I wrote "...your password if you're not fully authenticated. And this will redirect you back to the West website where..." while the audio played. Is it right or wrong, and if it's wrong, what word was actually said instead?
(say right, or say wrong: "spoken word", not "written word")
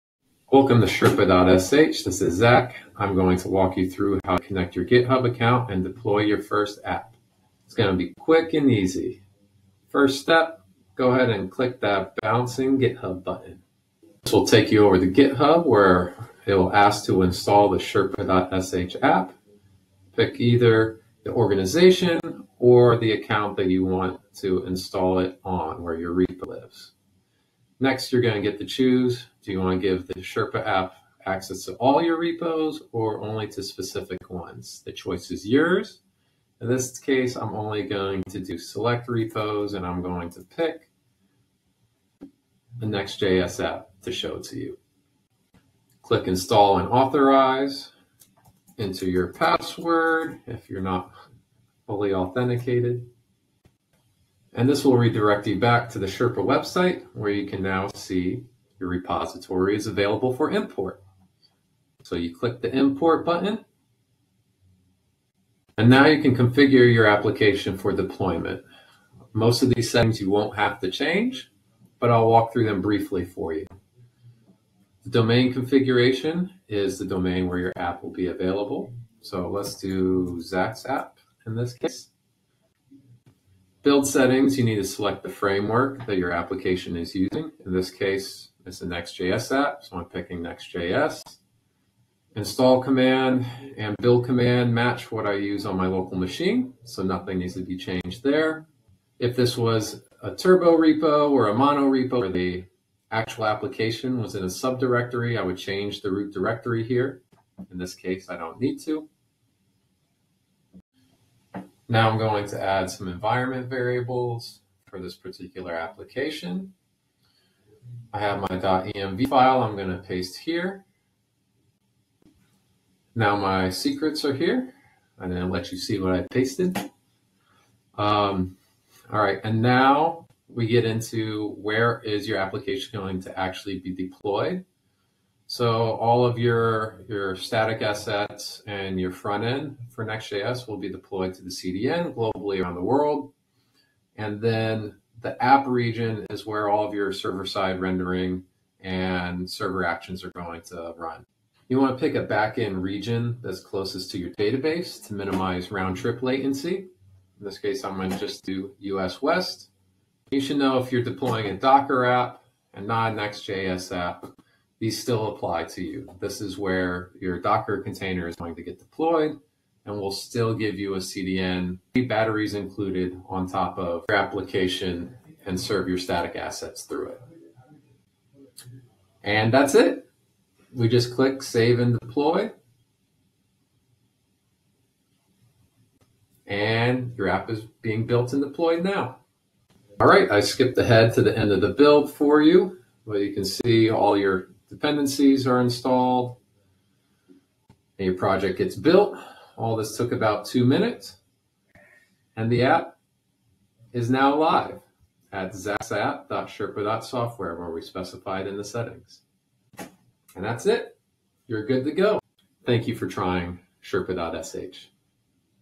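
wrong: "Sherpa", not "West".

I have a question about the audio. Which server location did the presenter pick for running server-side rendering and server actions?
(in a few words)
US West.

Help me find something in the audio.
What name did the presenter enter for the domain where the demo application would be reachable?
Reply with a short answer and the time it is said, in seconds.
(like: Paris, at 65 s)
Zach's app, at 80 s.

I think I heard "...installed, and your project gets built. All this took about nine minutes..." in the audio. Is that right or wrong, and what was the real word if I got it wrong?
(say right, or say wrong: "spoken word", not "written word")
wrong: "two", not "nine".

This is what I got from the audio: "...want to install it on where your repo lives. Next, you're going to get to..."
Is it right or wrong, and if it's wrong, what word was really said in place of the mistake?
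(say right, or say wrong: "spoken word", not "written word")
right.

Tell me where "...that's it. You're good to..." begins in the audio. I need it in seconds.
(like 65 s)
210 s.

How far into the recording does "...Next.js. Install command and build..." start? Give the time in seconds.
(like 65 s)
90 s.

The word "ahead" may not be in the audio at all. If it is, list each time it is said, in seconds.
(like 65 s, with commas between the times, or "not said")
11 s, 190 s.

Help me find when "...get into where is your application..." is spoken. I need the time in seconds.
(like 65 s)
130 s.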